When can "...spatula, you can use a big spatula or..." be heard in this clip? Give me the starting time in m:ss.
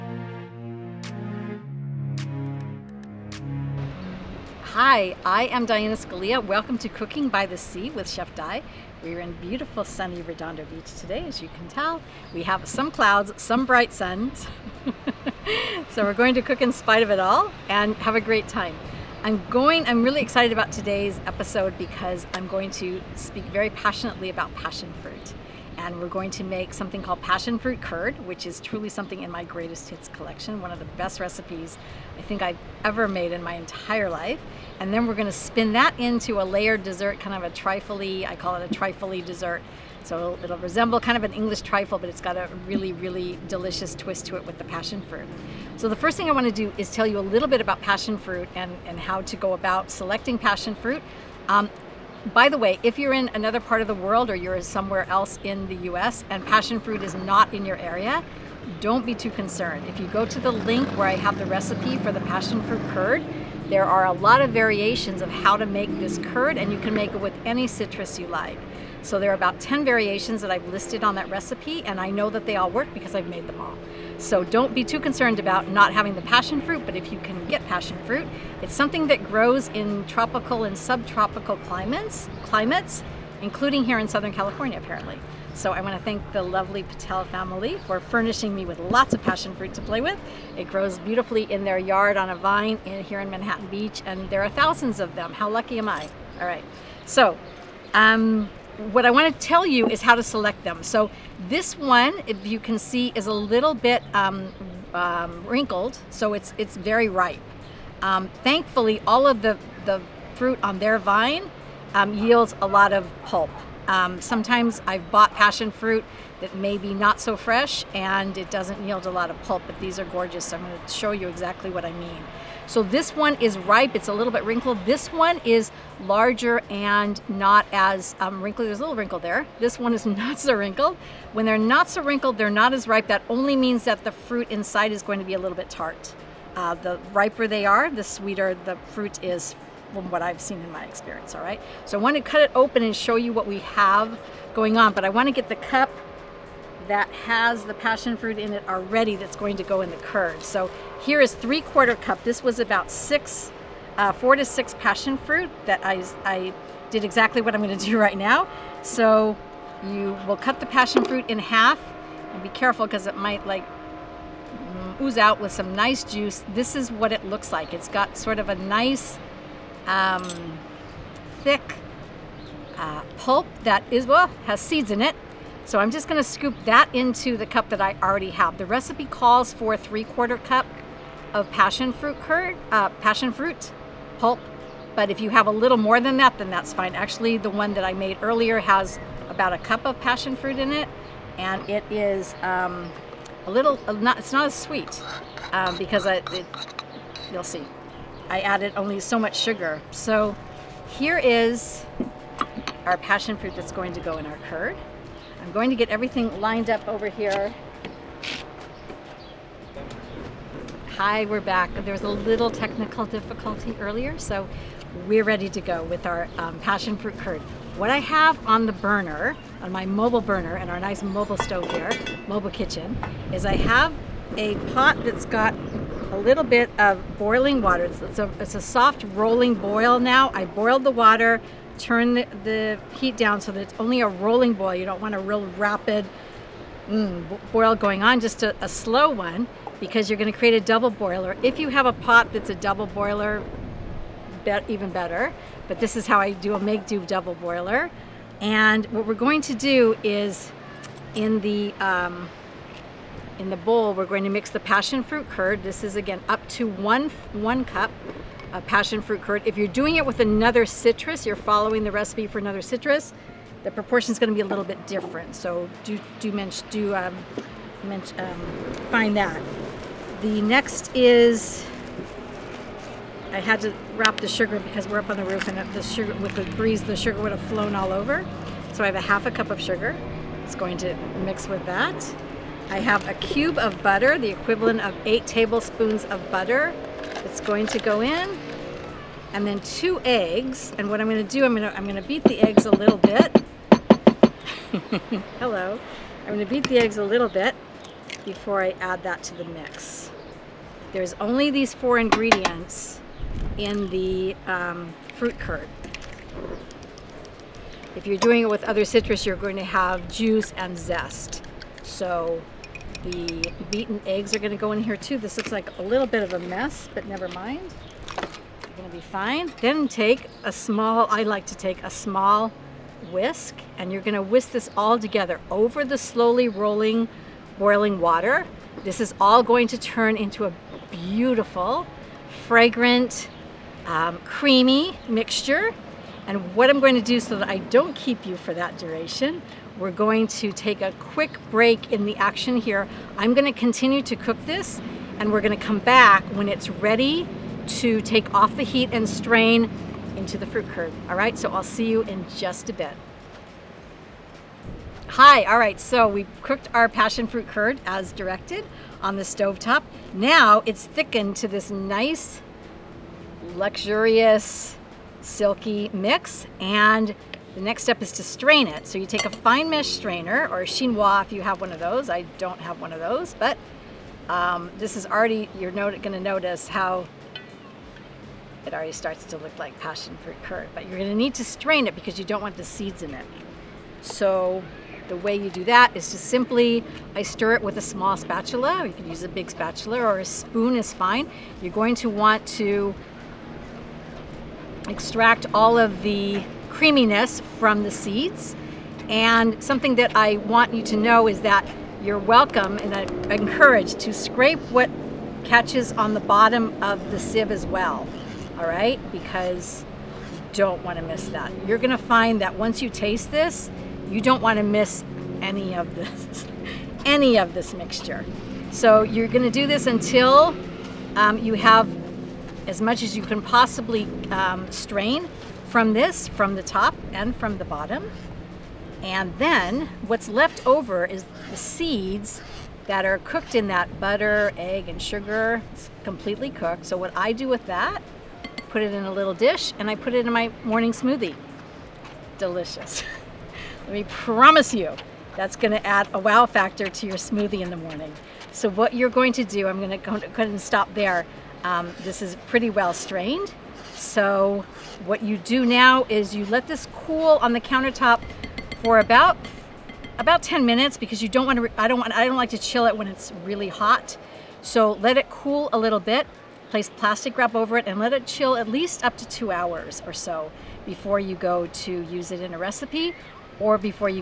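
6:28.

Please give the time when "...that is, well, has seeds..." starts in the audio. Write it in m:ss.
2:53.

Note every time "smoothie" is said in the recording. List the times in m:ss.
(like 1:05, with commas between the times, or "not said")
7:20, 7:27.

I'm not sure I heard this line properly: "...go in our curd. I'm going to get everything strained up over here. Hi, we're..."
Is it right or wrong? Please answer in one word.
wrong.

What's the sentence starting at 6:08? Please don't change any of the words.
So you take a fine mesh strainer or a chinois if you have one of those.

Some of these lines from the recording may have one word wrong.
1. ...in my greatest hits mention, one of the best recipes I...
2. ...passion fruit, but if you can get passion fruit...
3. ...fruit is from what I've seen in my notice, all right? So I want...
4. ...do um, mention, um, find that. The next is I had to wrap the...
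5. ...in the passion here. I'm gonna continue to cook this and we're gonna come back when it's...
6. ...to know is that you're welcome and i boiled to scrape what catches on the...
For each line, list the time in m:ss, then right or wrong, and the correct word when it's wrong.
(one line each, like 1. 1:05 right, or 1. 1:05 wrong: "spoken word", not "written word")
1. 0:29 wrong: "collection", not "mention"
2. 1:16 right
3. 2:18 wrong: "experience", not "notice"
4. 4:26 right
5. 5:41 wrong: "action", not "passion"
6. 6:40 wrong: "encouraged", not "boiled".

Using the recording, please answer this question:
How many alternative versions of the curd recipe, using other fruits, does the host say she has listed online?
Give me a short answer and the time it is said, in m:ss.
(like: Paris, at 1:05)
10, at 1:09.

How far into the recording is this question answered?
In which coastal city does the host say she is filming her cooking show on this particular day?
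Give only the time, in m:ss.
0:10.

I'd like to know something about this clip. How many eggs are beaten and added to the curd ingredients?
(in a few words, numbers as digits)
2.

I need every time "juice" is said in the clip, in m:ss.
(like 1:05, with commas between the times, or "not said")
2:46, 5:10.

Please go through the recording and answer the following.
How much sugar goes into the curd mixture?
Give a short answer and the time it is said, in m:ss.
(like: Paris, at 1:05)
1/2 cup, at 4:38.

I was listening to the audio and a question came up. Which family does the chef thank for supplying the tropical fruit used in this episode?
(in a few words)
Patel.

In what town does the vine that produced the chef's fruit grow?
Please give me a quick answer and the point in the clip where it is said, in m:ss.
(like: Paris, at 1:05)
Manhattan Beach, at 1:33.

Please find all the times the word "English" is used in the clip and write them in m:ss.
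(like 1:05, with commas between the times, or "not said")
0:41.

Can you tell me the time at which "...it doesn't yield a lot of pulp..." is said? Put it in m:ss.
1:58.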